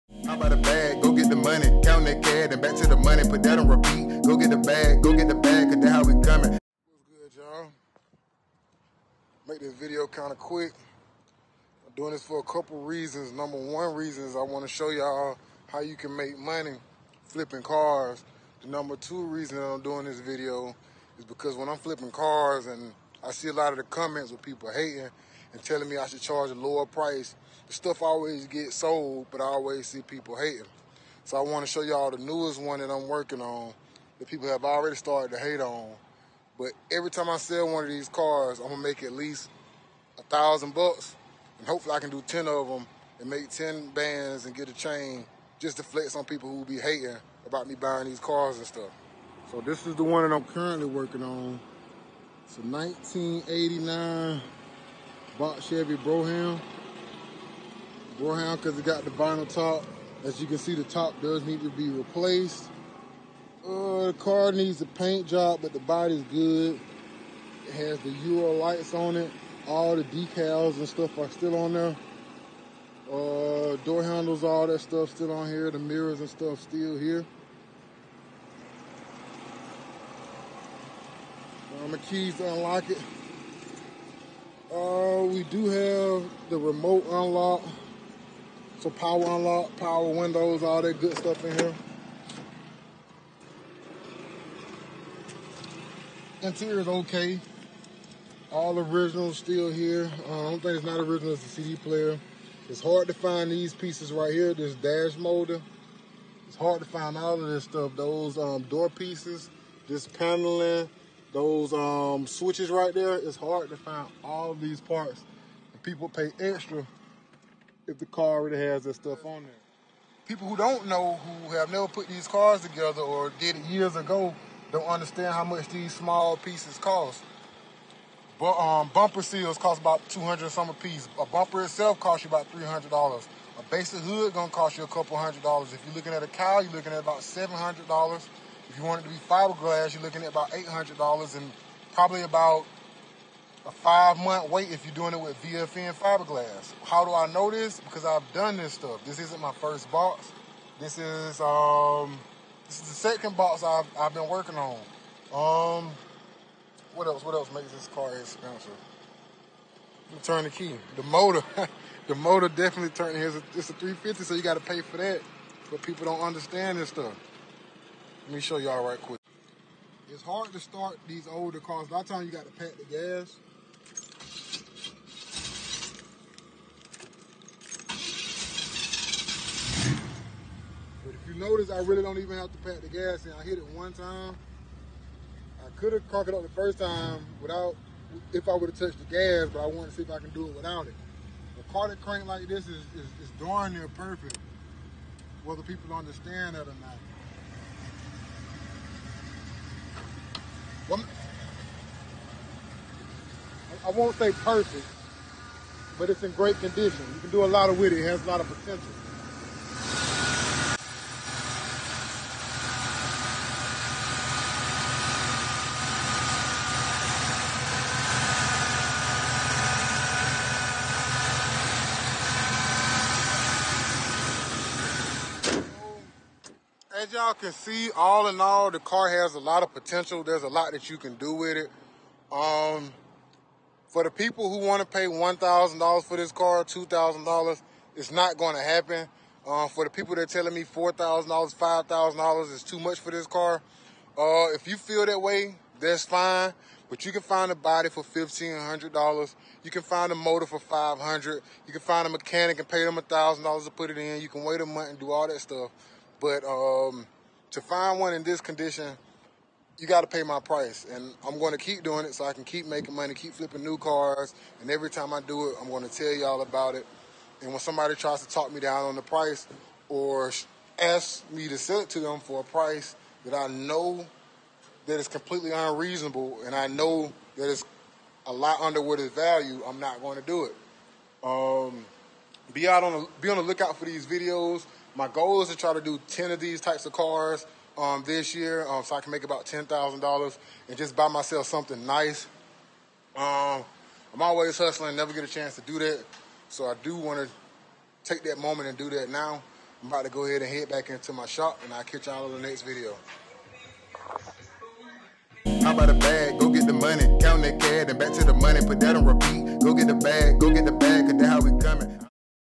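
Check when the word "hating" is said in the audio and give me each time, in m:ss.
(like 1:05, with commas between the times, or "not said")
0:24, 0:30, 0:46.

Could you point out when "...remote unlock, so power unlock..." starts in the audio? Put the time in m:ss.
1:26.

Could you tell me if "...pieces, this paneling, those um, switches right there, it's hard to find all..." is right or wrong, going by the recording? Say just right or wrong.
right.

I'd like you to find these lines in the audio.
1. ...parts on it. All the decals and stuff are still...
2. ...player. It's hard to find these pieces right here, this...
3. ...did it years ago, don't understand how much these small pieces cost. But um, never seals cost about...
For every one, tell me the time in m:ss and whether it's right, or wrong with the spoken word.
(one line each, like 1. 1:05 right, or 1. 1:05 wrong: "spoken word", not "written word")
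1. 1:08 wrong: "lights", not "parts"
2. 1:41 right
3. 2:03 wrong: "bumper", not "never".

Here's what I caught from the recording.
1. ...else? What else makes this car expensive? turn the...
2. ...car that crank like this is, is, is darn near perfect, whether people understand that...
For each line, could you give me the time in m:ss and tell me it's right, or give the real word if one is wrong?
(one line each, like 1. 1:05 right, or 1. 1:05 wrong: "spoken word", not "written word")
1. 2:37 right
2. 3:11 right.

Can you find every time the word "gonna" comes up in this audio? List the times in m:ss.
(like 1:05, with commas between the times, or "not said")
0:38, 2:14.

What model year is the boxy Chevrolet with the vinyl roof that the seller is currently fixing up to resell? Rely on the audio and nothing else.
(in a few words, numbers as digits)
1989.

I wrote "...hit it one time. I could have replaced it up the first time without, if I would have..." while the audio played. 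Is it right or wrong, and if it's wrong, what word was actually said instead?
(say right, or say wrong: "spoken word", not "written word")
wrong: "cranked", not "replaced".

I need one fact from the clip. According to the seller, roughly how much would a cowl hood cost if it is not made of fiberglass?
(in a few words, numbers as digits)
$700.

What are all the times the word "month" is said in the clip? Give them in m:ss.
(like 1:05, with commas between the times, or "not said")
2:24, 4:14.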